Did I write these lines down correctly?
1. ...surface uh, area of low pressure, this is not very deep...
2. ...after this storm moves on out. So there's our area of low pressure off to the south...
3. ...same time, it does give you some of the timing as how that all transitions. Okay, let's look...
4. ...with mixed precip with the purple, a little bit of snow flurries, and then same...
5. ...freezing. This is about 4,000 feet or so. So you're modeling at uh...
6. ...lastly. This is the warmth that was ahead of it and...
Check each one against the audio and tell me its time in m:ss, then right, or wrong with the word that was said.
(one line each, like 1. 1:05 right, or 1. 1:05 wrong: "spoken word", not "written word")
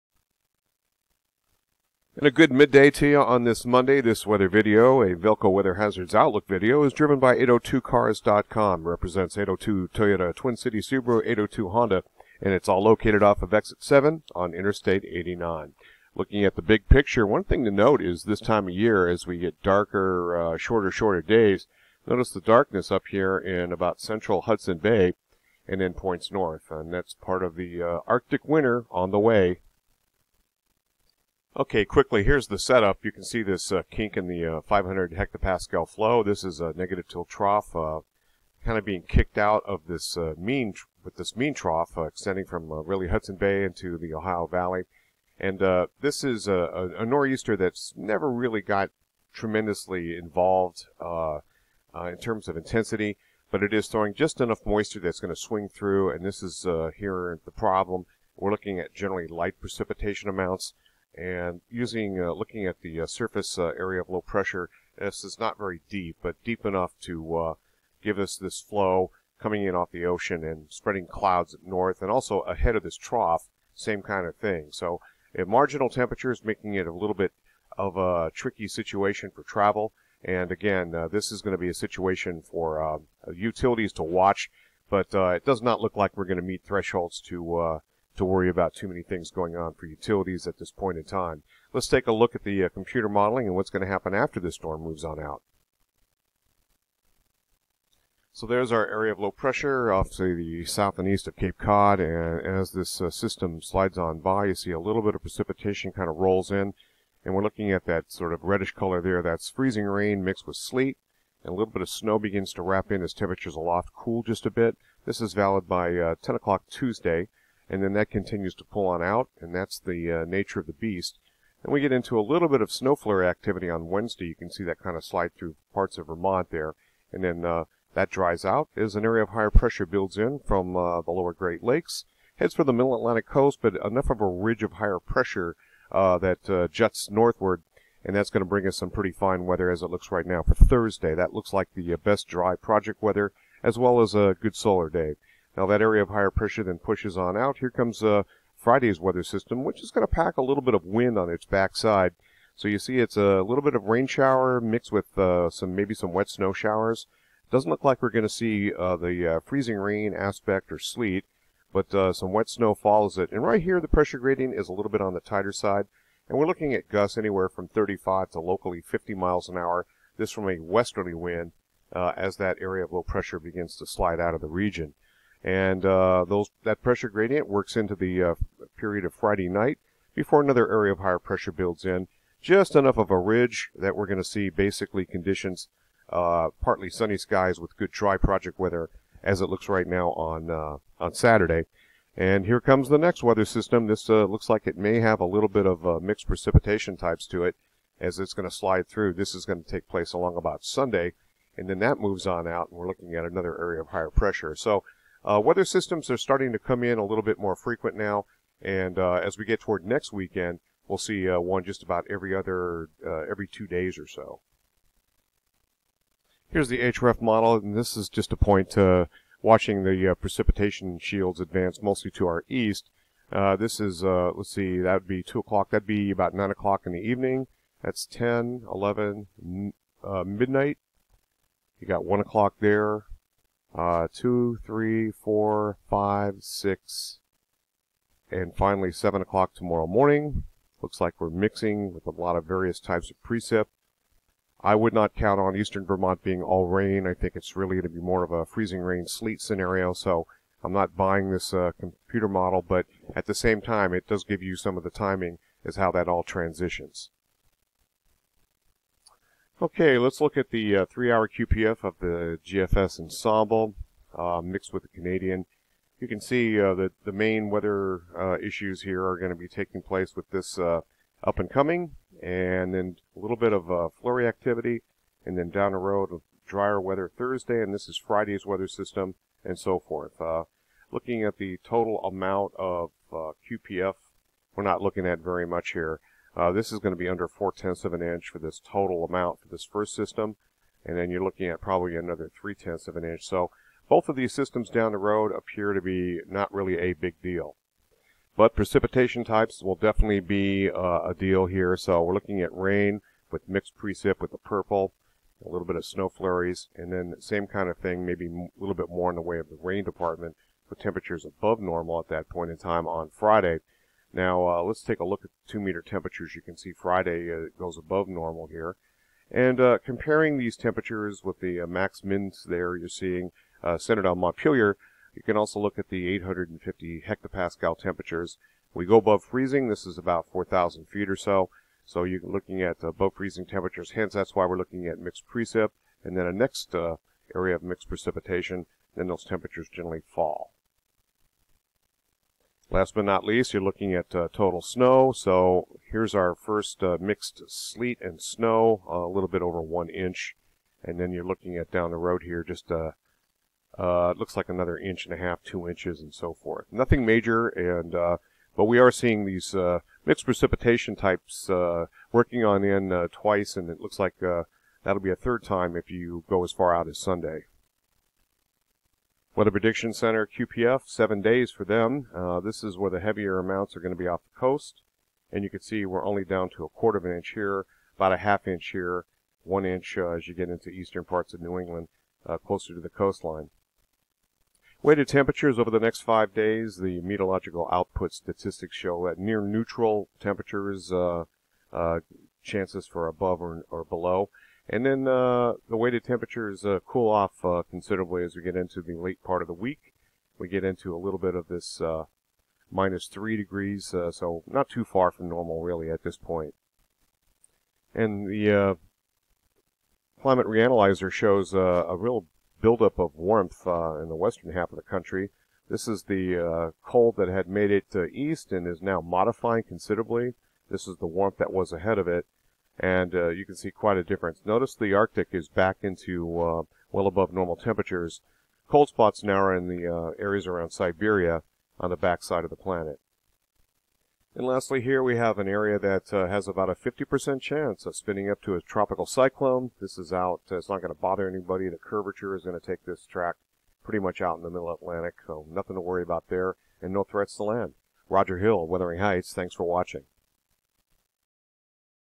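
1. 1:03 right
2. 1:34 right
3. 4:13 right
4. 5:03 right
5. 5:29 wrong: "looking", not "modeling"
6. 6:59 wrong: "considerably", not "lastly".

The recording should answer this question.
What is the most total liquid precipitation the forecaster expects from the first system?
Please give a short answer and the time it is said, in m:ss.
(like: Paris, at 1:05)
4 tenths, at 4:47.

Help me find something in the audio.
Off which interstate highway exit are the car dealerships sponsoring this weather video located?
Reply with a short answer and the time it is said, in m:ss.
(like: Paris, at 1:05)
Exit 7, at 0:13.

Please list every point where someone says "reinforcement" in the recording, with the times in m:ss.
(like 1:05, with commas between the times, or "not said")
not said.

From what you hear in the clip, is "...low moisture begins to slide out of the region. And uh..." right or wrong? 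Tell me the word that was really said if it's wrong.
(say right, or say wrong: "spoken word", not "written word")
wrong: "pressure", not "moisture".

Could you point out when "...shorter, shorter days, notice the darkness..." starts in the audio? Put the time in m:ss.
0:20.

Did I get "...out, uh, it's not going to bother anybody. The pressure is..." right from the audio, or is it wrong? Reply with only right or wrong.
wrong.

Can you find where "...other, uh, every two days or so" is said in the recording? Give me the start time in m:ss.
3:32.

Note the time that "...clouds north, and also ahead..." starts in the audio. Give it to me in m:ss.
1:11.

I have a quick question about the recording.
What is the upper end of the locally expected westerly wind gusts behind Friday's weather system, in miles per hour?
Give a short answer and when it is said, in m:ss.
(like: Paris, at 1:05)
50, at 2:48.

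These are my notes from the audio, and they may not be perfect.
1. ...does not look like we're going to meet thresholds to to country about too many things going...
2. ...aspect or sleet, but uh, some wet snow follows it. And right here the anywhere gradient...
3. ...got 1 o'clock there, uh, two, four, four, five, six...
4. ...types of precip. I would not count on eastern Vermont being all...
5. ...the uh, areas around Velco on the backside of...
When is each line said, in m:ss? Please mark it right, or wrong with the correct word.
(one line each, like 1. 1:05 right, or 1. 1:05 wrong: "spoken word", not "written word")
1. 1:25 wrong: "worry", not "country"
2. 2:40 wrong: "pressure", not "anywhere"
3. 3:51 wrong: "three", not "four"
4. 4:02 right
5. 7:09 wrong: "Siberia", not "Velco".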